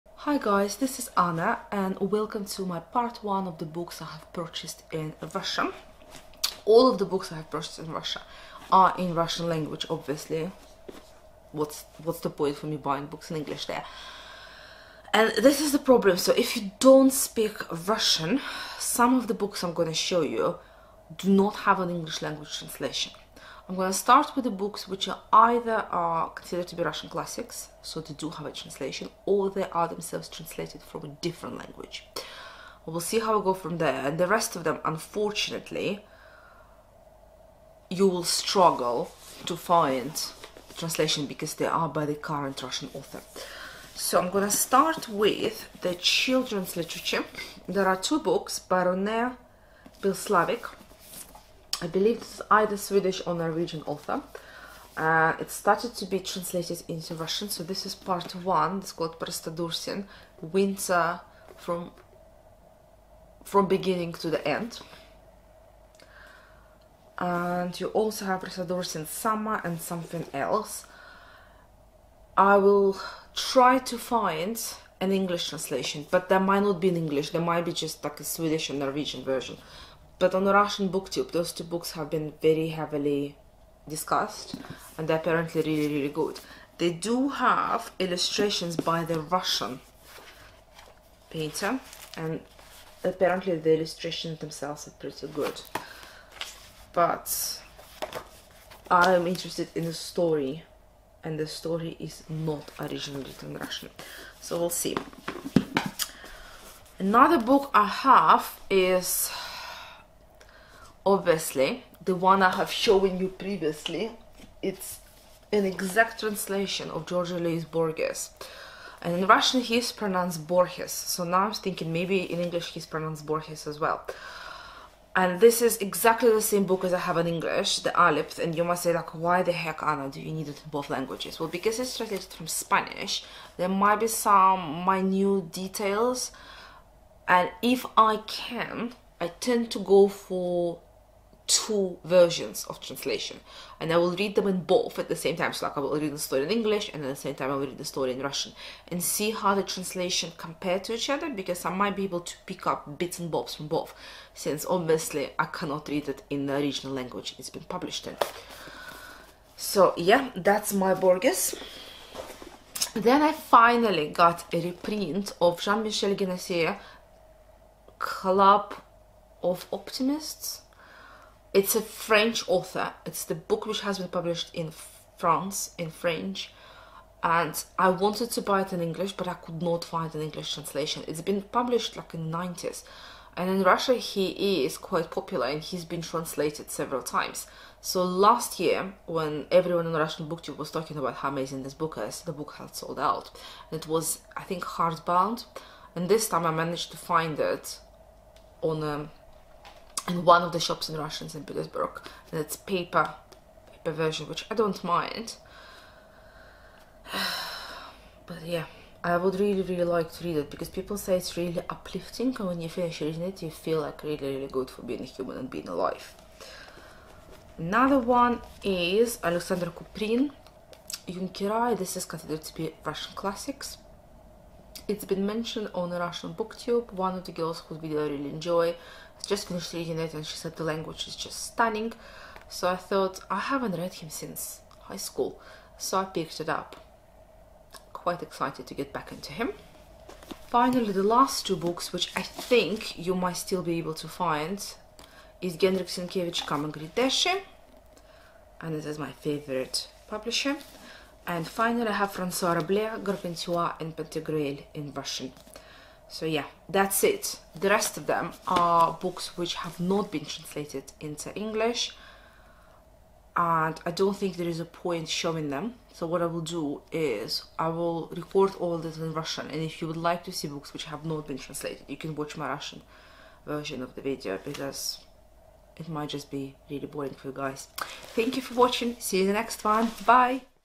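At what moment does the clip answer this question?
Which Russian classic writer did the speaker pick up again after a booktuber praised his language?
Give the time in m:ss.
3:39.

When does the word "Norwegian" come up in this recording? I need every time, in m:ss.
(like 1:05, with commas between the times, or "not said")
0:53, 1:18.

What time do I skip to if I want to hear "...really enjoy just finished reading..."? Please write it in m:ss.
3:48.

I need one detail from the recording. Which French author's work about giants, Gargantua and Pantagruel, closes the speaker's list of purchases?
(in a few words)
Francois Rabelais.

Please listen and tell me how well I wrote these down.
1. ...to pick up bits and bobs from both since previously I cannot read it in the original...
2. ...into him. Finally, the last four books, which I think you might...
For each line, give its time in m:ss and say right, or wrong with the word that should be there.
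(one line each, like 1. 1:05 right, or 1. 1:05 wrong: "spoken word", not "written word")
1. 2:32 wrong: "obviously", not "previously"
2. 3:59 wrong: "two", not "four".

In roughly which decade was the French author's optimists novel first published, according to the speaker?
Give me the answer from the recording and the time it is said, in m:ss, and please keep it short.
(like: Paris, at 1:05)
the 90s, at 3:02.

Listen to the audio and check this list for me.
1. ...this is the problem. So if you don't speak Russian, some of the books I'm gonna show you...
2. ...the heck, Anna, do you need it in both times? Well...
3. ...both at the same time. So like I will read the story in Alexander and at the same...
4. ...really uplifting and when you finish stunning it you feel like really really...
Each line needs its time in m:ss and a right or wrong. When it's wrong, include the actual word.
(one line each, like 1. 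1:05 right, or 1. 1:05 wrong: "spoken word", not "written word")
1. 0:15 right
2. 2:09 wrong: "languages", not "times"
3. 2:24 wrong: "English", not "Alexander"
4. 3:31 wrong: "reading", not "stunning".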